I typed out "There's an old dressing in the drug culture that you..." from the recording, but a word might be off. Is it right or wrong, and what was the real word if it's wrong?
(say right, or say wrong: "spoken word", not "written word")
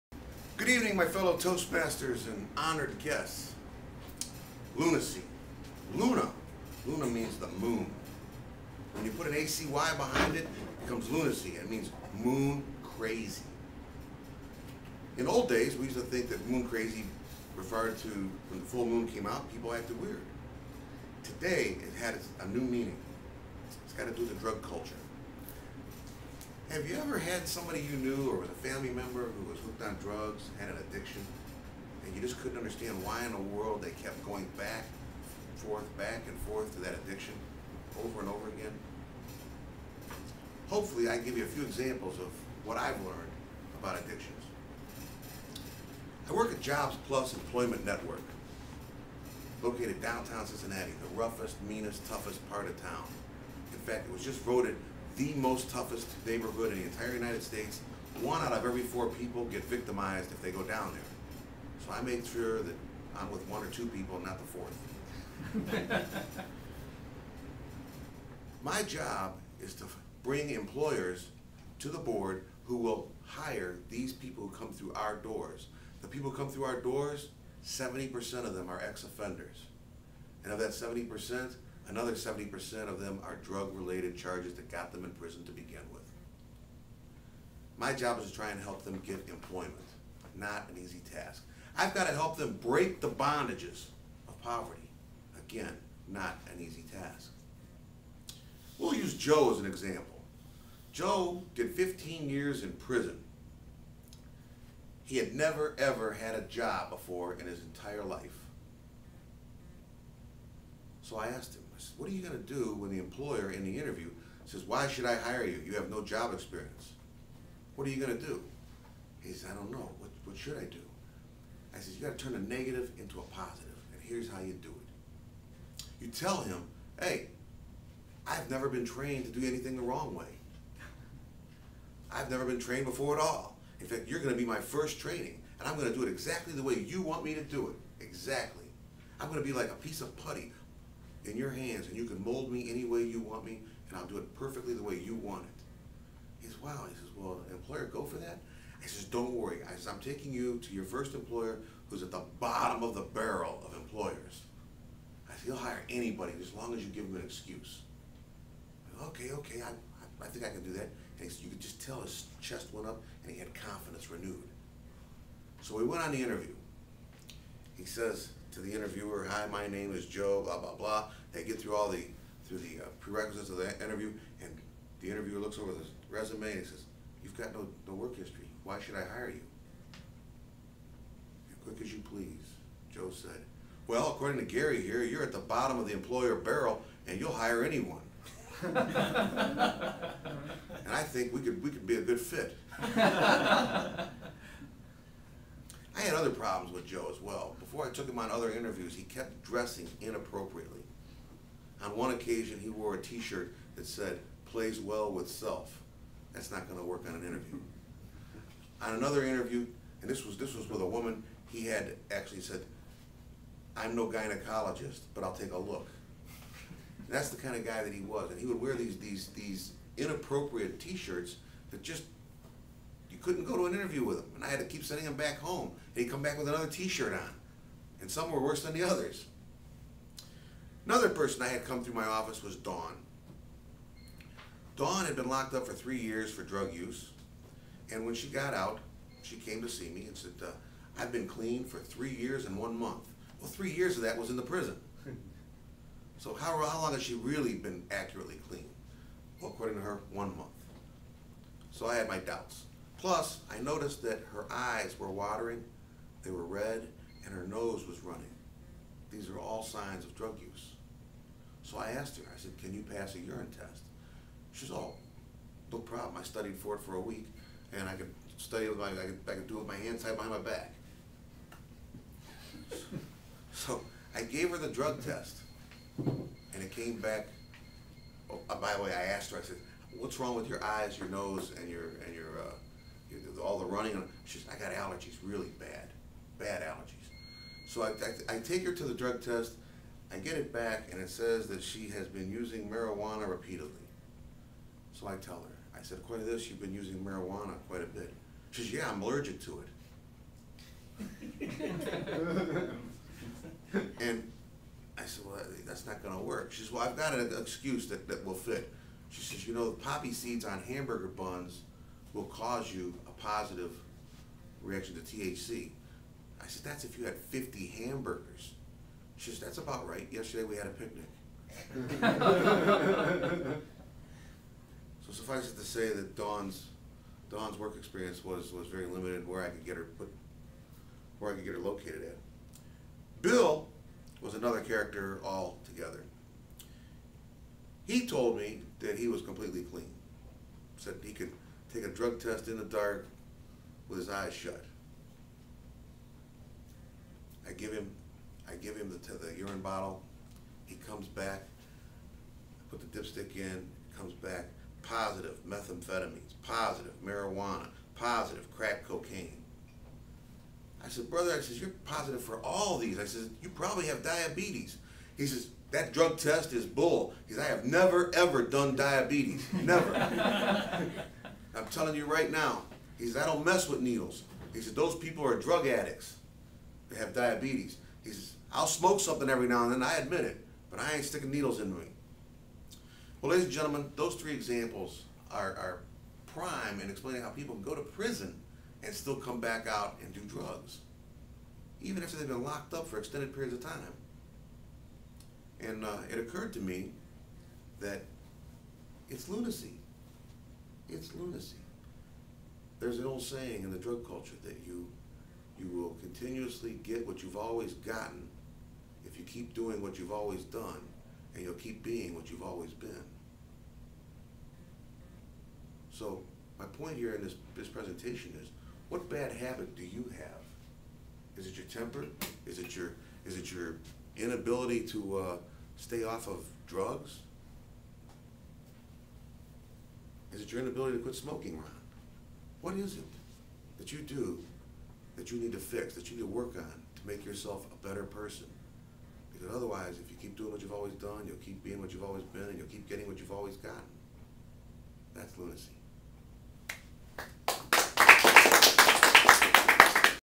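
wrong: "saying", not "dressing".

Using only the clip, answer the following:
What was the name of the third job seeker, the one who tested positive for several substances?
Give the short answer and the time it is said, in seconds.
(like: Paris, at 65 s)
Bill, at 333 s.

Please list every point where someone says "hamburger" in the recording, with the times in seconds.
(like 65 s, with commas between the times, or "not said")
310 s, 317 s.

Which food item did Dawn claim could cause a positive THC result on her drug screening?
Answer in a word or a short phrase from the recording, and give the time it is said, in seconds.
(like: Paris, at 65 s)
poppy seeds, at 309 s.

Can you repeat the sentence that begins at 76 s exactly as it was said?
The people who come through our doors, 70% of them are ex-offenders.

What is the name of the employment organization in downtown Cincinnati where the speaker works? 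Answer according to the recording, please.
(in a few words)
Jobs Plus Employment Network.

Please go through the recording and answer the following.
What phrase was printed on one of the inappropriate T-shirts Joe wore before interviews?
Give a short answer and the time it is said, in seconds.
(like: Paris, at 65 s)
plays well with self, at 204 s.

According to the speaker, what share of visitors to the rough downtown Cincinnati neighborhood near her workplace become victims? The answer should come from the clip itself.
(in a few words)
One out of every four.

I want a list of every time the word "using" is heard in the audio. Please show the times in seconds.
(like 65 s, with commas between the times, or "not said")
292 s, 296 s.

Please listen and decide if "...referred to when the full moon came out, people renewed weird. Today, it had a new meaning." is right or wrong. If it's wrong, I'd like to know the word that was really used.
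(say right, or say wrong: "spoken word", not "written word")
wrong: "acted", not "renewed".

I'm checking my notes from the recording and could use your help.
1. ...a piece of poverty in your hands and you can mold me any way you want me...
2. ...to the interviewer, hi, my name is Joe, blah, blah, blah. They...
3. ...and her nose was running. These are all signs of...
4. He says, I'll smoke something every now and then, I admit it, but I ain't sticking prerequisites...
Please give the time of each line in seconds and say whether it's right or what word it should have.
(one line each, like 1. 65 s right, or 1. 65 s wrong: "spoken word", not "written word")
1. 139 s wrong: "putty", not "poverty"
2. 168 s right
3. 257 s right
4. 378 s wrong: "needles", not "prerequisites".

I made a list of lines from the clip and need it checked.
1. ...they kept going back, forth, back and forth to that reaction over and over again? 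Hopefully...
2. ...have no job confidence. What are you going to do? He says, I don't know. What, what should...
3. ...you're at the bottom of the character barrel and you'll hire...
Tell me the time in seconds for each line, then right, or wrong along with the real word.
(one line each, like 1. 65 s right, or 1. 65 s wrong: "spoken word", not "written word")
1. 33 s wrong: "addiction", not "reaction"
2. 115 s wrong: "experience", not "confidence"
3. 185 s wrong: "employer", not "character".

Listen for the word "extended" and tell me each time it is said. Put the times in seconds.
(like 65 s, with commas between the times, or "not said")
392 s.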